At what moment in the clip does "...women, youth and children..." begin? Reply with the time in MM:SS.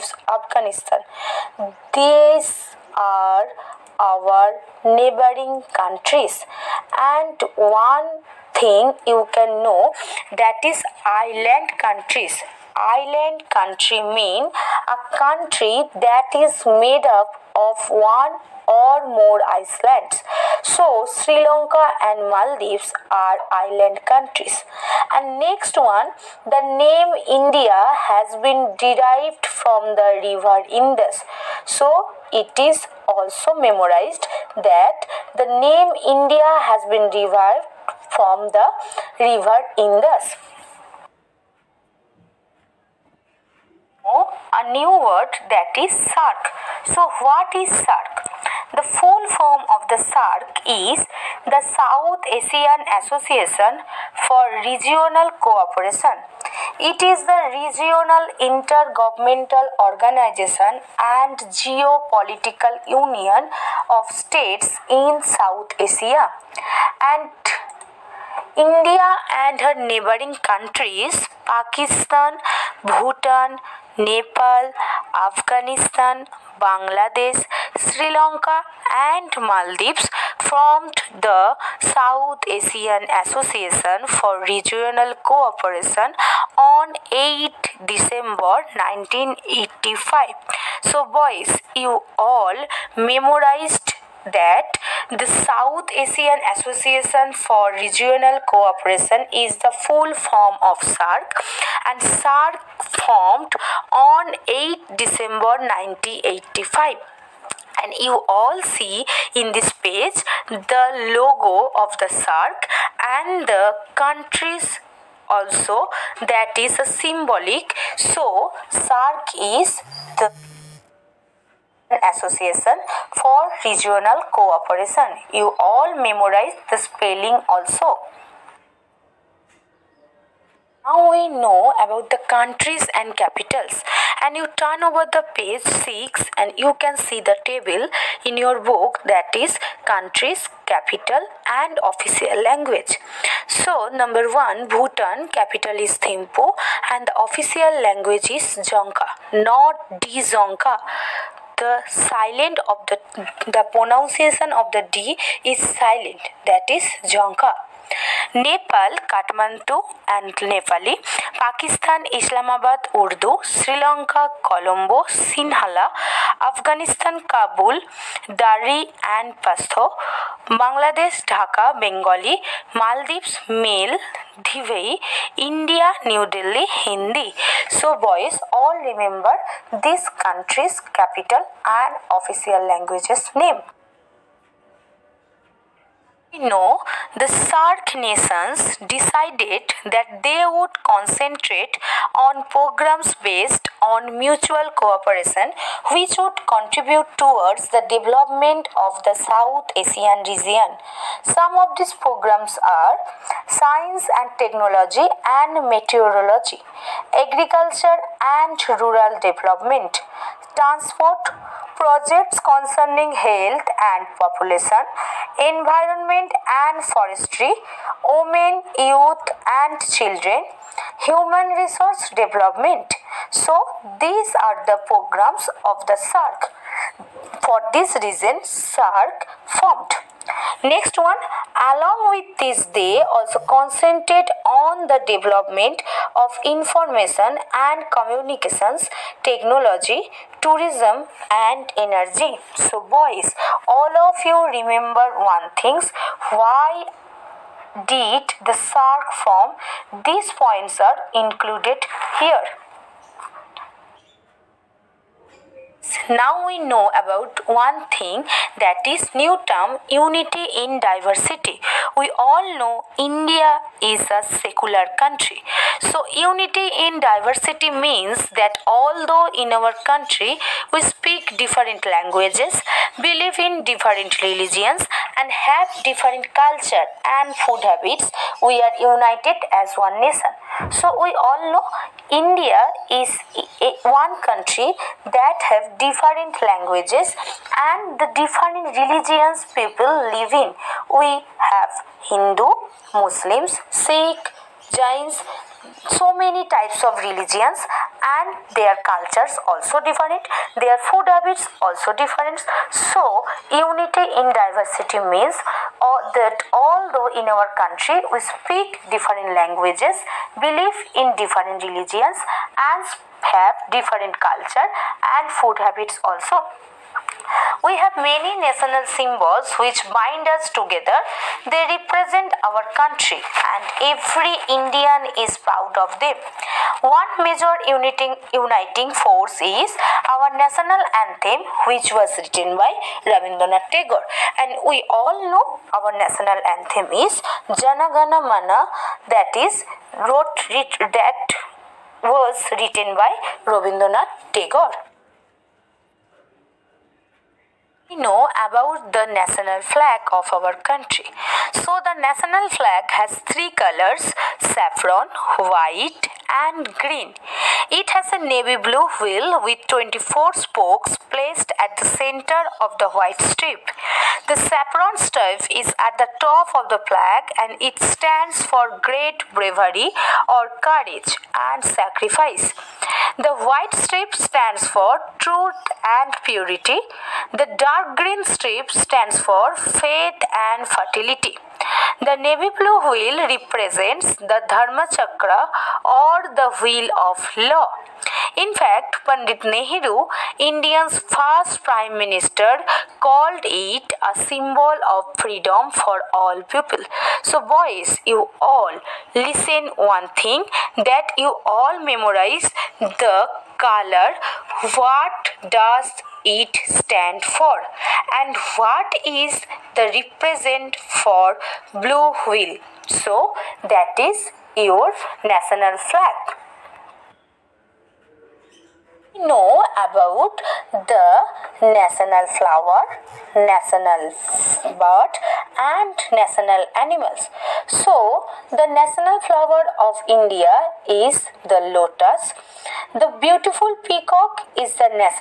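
03:38.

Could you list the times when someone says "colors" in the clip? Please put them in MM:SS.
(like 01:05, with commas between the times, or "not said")
05:53, 06:43.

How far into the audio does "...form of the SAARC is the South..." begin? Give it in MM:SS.
00:49.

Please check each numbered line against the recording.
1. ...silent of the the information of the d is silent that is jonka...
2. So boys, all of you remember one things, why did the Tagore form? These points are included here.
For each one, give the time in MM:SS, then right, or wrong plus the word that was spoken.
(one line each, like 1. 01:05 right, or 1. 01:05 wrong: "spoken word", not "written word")
1. 02:31 wrong: "pronunciation", not "information"
2. 04:02 wrong: "SAARC", not "Tagore".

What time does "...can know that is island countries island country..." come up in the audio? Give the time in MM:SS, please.
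00:09.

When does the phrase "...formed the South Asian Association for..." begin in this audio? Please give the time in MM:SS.
01:20.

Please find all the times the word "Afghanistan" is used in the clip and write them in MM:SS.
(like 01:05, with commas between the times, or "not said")
00:00, 01:15.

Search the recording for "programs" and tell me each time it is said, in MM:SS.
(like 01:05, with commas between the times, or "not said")
03:12, 03:21, 03:44.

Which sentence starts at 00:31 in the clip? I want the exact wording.
So, it is also memorized that the name India has been derived from the river Indus.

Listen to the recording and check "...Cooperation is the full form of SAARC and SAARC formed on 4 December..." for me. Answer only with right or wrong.
wrong.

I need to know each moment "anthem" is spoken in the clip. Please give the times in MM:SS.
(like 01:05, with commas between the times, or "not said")
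05:31, 05:36.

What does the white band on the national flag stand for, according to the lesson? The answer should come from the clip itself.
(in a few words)
truth and purity.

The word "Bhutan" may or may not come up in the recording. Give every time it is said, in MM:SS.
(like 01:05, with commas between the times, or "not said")
01:12, 02:24.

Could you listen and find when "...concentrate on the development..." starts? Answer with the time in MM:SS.
03:53.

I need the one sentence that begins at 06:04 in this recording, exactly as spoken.
The saffron stripe is at the top of the flag and it stands for great bravery or courage and sacrifice.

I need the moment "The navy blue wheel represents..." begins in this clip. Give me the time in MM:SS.
06:22.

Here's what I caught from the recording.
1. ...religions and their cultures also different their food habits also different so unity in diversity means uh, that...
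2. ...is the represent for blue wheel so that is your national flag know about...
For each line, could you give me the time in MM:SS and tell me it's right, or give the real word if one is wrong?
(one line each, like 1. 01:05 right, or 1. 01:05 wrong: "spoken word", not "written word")
1. 04:57 right
2. 06:49 right.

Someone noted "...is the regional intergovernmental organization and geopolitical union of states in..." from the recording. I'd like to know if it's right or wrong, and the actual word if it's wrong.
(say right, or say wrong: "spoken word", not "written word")
right.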